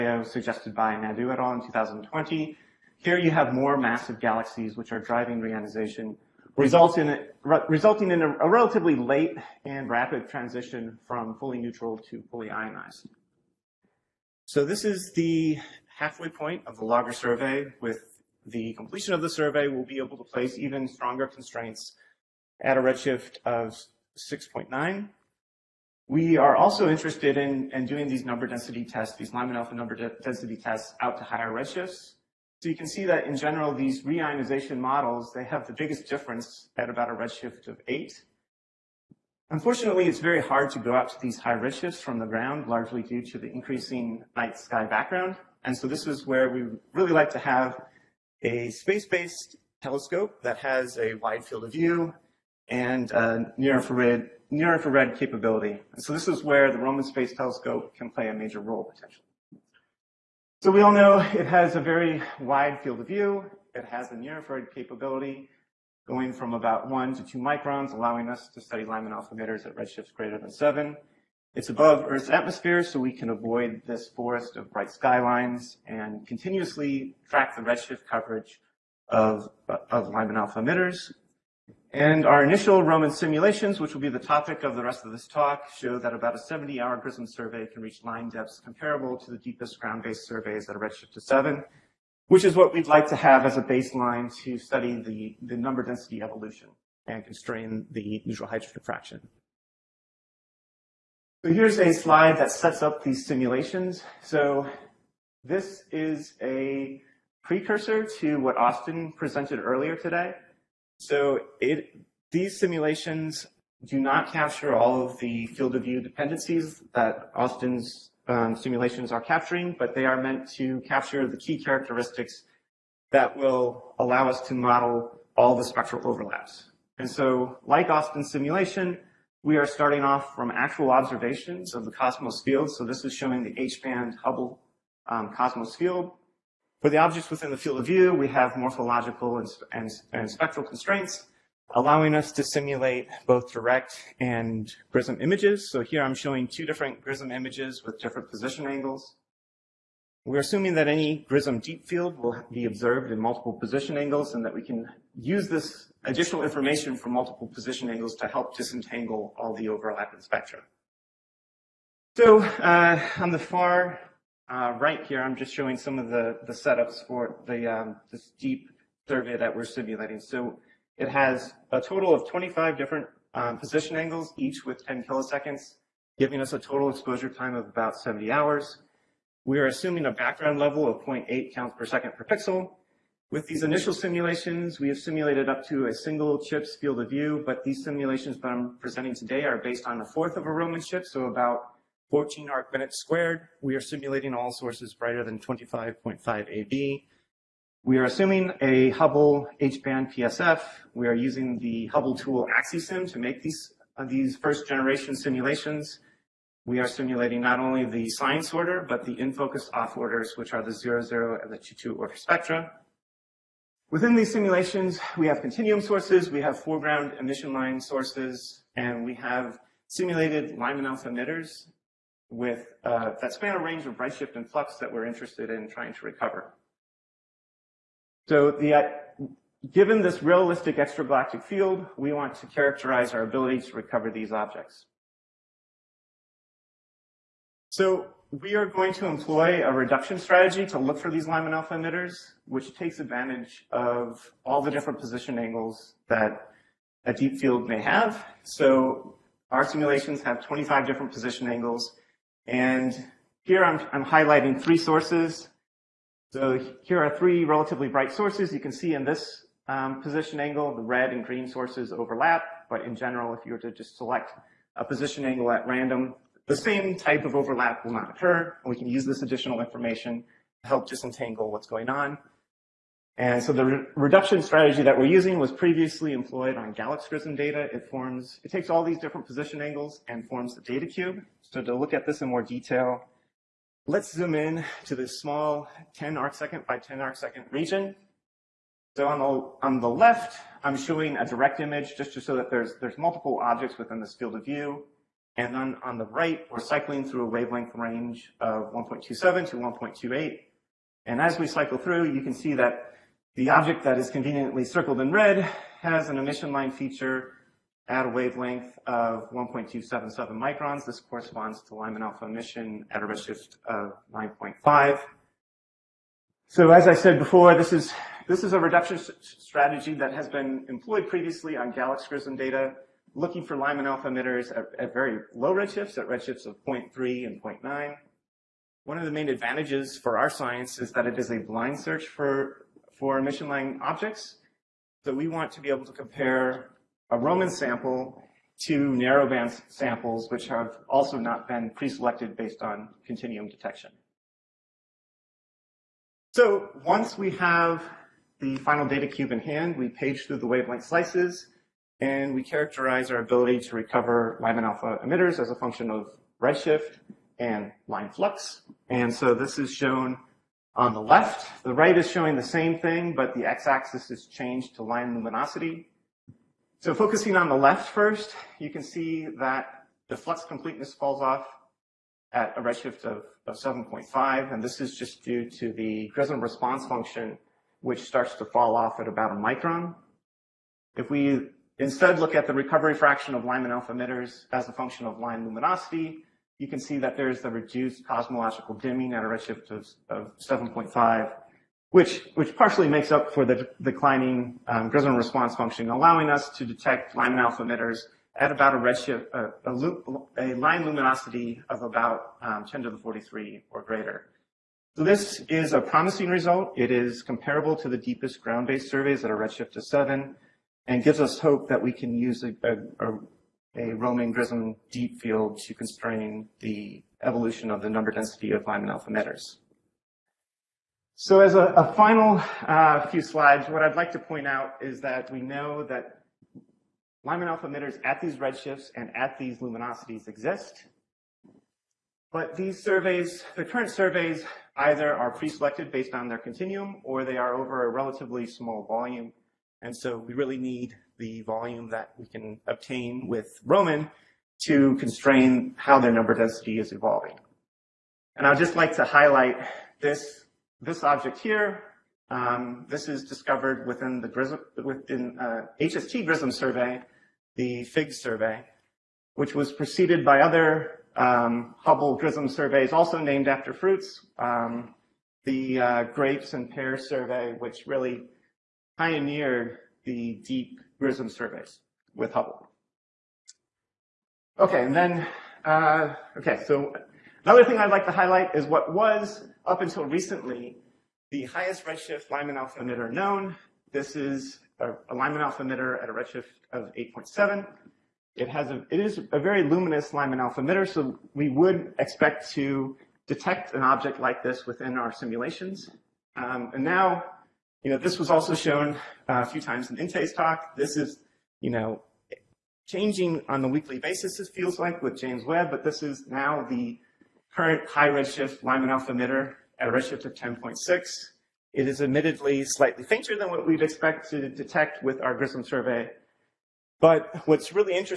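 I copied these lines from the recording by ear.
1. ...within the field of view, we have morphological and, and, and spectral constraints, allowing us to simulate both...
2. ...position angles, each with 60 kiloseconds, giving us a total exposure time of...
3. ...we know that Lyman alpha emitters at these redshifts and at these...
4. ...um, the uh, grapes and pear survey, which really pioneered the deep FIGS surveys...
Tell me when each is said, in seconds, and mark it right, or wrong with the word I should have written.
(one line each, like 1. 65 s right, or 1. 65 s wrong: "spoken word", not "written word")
1. 137 s right
2. 173 s wrong: "10", not "60"
3. 425 s right
4. 464 s wrong: "GRISM", not "FIGS".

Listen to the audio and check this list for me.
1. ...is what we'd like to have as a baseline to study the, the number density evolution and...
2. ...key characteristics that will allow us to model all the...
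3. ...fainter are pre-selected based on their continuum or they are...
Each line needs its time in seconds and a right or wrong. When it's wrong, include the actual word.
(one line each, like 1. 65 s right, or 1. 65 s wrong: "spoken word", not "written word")
1. 92 s right
2. 121 s right
3. 434 s wrong: "either", not "fainter".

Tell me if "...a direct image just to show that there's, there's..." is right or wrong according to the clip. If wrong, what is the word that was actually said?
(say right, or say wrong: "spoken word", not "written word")
right.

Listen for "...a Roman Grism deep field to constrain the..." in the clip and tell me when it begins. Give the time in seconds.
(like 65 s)
413 s.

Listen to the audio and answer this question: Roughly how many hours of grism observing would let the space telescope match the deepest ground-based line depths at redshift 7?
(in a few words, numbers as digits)
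70.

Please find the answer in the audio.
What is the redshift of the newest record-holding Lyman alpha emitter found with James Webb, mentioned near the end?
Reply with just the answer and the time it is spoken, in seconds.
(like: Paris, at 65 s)
10.6, at 510 s.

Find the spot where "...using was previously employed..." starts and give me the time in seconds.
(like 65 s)
275 s.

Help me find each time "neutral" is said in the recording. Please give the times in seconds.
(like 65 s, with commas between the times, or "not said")
11 s, 98 s.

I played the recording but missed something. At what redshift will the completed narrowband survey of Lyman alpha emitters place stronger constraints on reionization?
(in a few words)
6.9.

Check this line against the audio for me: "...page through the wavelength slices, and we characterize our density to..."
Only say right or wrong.
wrong.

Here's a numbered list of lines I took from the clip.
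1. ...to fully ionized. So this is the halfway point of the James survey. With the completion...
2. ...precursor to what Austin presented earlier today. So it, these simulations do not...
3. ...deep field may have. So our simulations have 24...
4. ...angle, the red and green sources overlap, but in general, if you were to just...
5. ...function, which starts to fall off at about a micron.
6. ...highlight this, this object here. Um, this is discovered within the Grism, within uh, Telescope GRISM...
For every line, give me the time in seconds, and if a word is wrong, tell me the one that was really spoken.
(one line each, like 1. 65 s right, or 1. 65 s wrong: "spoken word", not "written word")
1. 12 s wrong: "LAGER", not "James"
2. 107 s right
3. 247 s wrong: "25", not "24"
4. 260 s right
5. 376 s right
6. 449 s wrong: "HST", not "Telescope".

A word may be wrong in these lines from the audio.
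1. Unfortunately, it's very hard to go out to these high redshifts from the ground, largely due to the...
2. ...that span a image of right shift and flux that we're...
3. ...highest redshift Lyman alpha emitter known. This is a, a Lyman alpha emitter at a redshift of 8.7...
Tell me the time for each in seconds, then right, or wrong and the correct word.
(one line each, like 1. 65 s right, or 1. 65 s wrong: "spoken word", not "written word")
1. 39 s right
2. 223 s wrong: "range", not "image"
3. 481 s right.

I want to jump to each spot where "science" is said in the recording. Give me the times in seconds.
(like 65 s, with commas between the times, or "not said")
208 s, 330 s.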